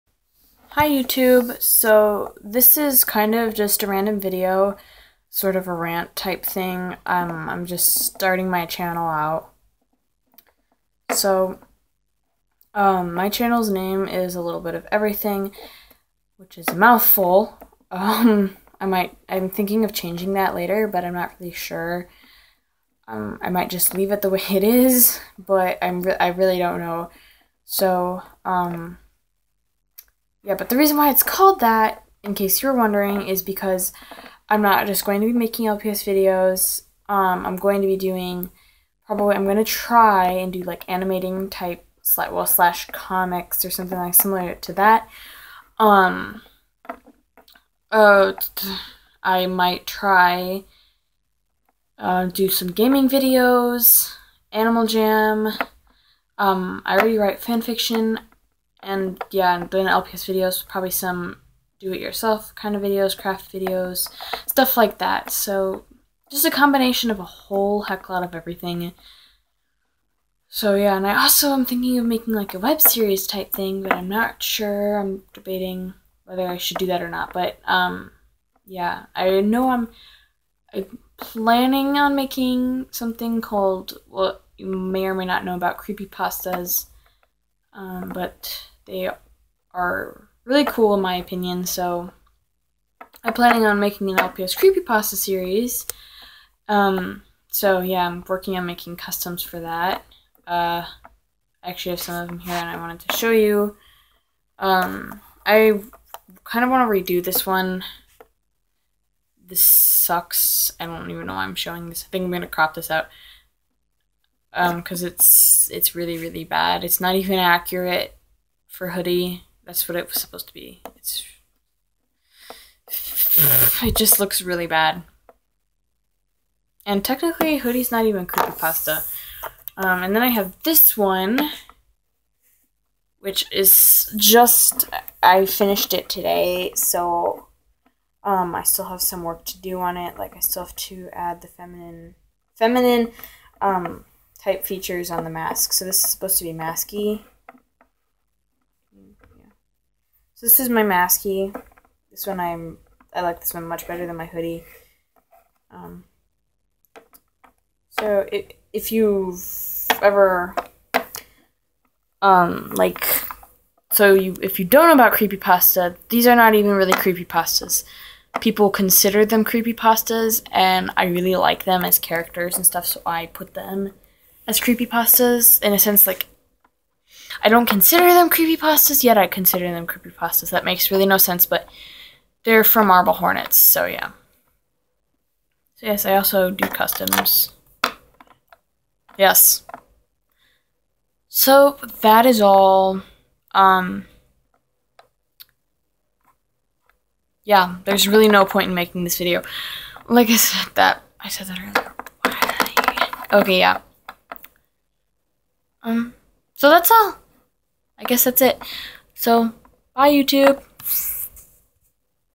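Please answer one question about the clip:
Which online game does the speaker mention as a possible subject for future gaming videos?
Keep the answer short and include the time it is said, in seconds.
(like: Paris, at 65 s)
Animal Jam, at 54 s.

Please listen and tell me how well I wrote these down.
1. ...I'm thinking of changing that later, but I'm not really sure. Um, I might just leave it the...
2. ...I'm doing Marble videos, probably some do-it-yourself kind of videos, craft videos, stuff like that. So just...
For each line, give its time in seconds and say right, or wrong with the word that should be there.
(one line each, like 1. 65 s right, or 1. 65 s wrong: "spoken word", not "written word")
1. 19 s right
2. 59 s wrong: "LPS", not "Marble".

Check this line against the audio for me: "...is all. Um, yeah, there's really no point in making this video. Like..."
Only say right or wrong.
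right.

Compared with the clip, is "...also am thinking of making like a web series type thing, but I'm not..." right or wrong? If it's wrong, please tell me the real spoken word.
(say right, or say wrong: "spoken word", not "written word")
right.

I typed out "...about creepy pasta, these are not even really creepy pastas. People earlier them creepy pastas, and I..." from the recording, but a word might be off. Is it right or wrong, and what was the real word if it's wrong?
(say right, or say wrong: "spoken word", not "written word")
wrong: "consider", not "earlier".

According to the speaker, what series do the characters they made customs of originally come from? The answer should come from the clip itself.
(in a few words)
Marble Hornets.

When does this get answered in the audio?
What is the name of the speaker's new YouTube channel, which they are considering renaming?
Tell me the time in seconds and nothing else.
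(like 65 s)
14 s.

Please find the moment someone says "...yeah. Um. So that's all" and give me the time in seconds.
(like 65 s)
203 s.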